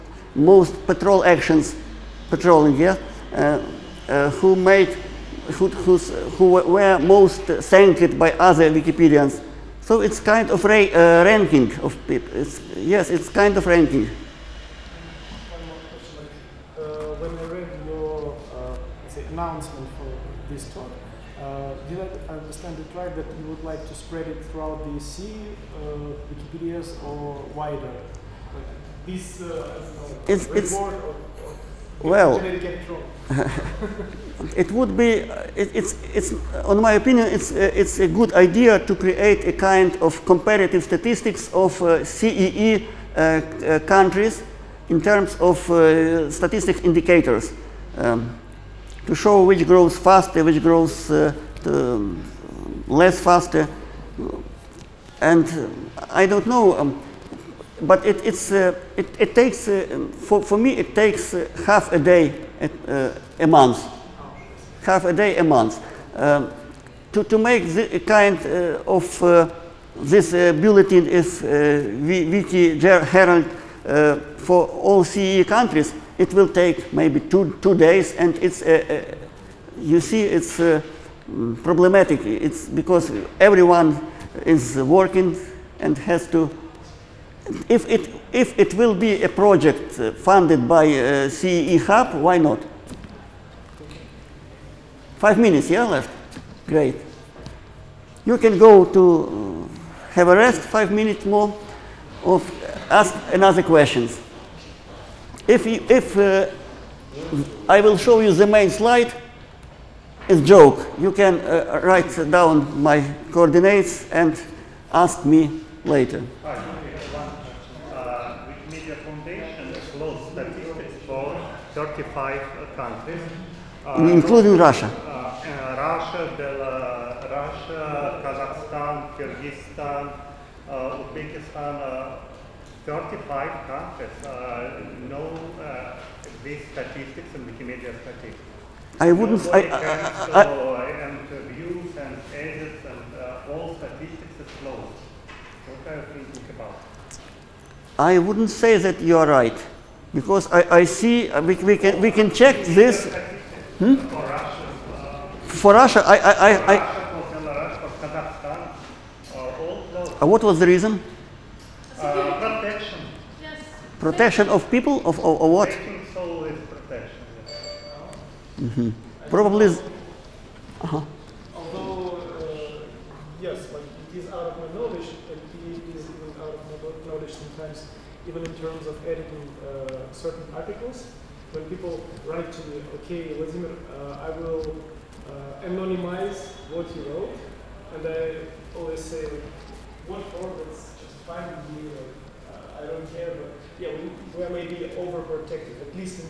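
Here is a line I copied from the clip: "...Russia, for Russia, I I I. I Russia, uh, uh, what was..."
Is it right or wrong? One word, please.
right.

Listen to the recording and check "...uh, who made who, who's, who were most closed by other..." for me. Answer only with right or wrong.
wrong.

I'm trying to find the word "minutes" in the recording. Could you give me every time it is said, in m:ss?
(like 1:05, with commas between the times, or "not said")
1:35, 1:40.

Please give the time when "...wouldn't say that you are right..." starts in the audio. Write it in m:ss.
2:28.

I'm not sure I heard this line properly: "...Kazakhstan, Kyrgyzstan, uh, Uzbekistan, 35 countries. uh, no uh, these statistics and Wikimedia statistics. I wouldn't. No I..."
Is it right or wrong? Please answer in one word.
right.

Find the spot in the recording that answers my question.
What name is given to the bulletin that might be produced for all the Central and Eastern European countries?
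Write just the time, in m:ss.
1:12.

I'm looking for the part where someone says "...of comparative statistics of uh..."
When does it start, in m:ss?
0:40.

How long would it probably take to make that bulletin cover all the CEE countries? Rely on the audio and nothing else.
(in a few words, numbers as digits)
2 days.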